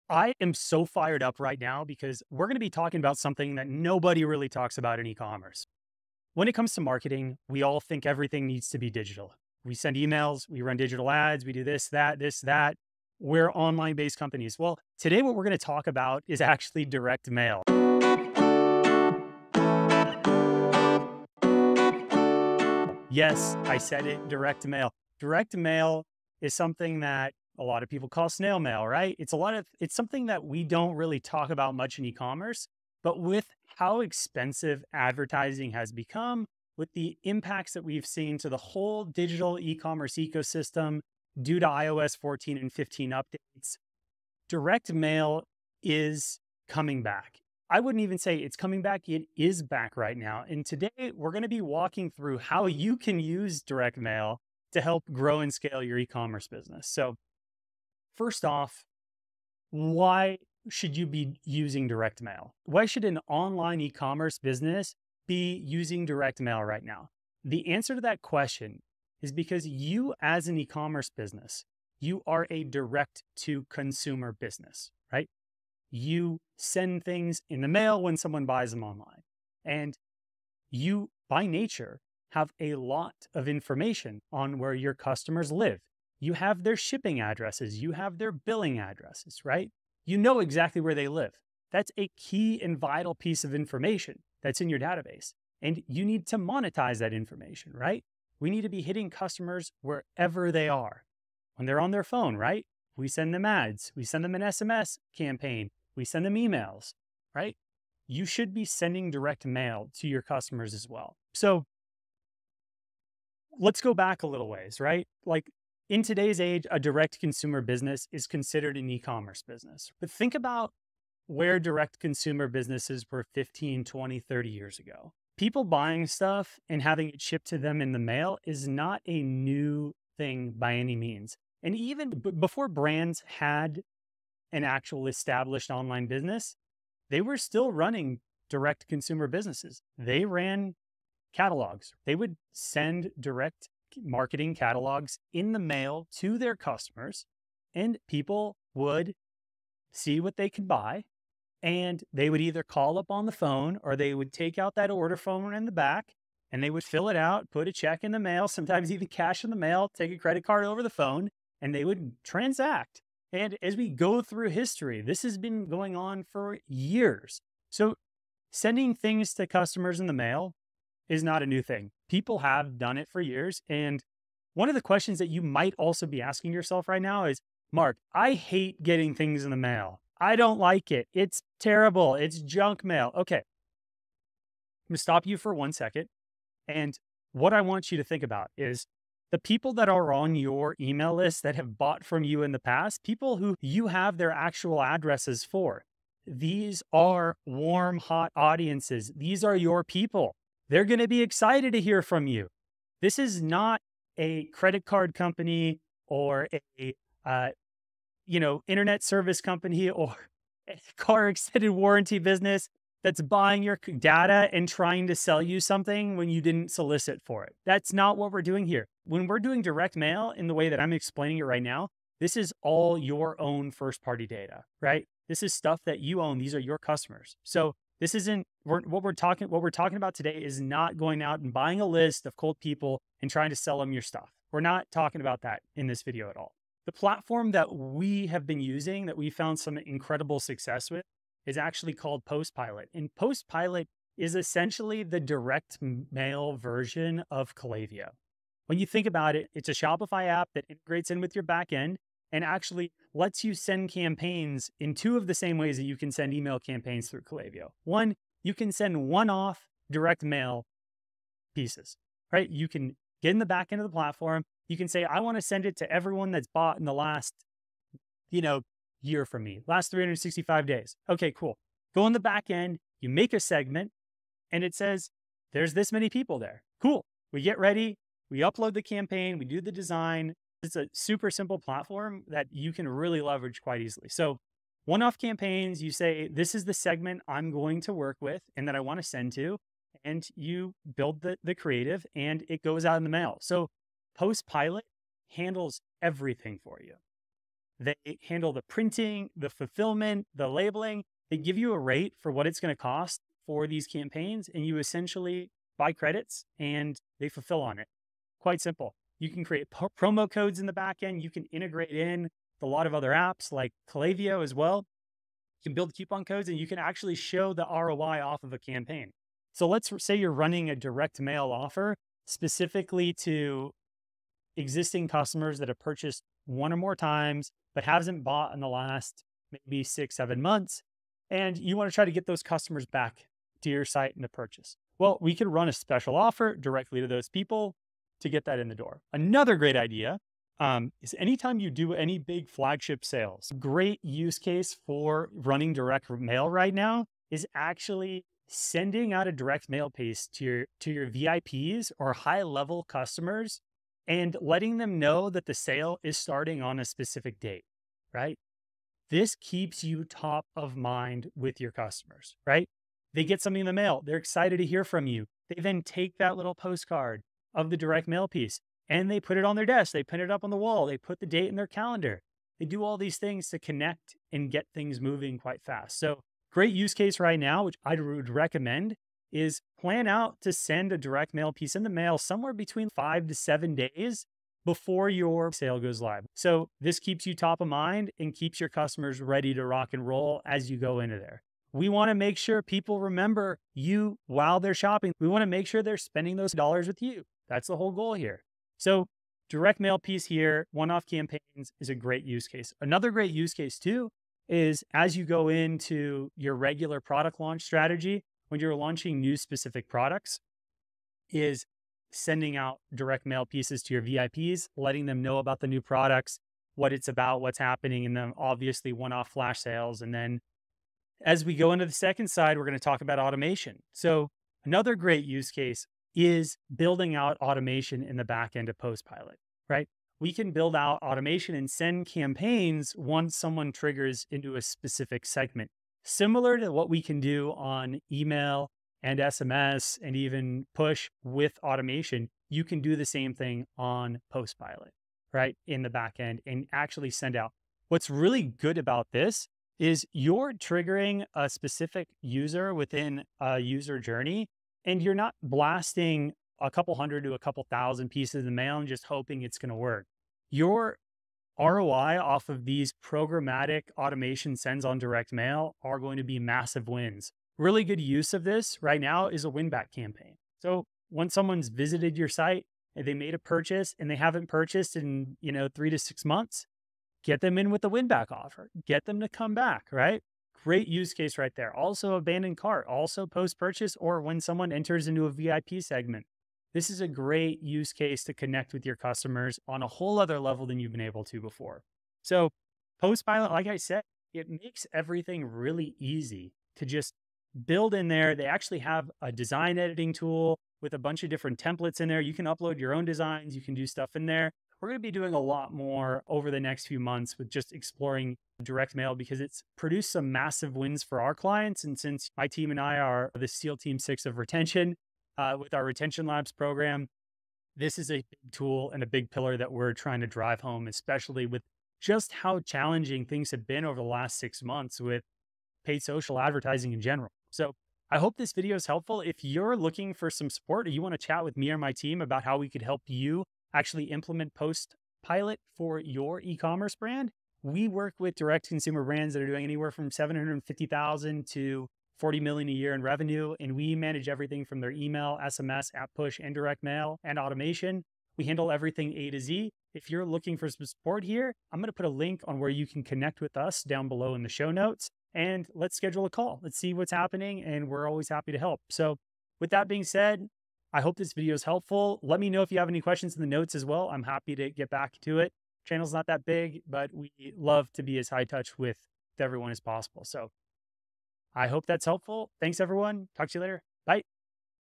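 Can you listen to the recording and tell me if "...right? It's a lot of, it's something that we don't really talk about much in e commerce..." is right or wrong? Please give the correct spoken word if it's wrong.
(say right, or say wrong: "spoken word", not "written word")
right.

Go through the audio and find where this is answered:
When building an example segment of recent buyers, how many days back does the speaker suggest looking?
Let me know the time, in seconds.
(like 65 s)
269 s.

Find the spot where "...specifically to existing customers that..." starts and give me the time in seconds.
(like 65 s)
322 s.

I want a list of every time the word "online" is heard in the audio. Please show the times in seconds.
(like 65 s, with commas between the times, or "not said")
13 s, 63 s, 78 s, 135 s.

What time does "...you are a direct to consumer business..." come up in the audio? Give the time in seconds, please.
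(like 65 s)
71 s.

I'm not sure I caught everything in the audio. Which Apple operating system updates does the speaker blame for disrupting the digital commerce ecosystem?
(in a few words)
iOS 14 and 15.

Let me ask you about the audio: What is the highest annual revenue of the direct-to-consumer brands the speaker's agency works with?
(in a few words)
40 million.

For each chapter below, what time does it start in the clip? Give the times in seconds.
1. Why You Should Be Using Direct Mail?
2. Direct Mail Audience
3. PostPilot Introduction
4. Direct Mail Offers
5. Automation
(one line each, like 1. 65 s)
1. 58 s
2. 168 s
3. 236 s
4. 320 s
5. 420 s.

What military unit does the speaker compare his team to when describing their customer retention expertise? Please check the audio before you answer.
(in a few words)
SEAL Team Six.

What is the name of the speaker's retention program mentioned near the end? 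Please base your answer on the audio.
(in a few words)
Retention Labs.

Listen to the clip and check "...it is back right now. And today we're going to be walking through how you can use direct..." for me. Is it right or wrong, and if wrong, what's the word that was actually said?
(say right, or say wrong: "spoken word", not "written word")
right.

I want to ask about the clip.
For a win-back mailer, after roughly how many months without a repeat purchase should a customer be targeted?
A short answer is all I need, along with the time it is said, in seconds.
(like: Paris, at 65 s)
3 to 6 months, at 475 s.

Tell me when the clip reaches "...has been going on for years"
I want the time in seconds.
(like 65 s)
165 s.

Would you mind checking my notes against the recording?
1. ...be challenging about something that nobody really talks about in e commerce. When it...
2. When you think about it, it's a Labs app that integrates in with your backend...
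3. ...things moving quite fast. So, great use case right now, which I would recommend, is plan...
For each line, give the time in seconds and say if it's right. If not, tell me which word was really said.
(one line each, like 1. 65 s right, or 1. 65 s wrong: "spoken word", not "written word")
1. 2 s wrong: "talking", not "challenging"
2. 248 s wrong: "Shopify", not "Labs"
3. 374 s right.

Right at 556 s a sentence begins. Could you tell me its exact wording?
Let's see what's happening, and we're always happy to help.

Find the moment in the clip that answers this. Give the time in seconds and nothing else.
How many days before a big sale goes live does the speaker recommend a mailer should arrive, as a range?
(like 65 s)
382 s.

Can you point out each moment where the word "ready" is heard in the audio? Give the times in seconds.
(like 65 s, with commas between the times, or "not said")
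277 s, 389 s.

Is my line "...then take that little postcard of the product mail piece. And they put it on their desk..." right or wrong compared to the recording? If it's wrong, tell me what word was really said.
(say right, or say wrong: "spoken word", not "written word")
wrong: "direct", not "product".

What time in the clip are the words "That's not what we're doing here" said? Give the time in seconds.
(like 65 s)
217 s.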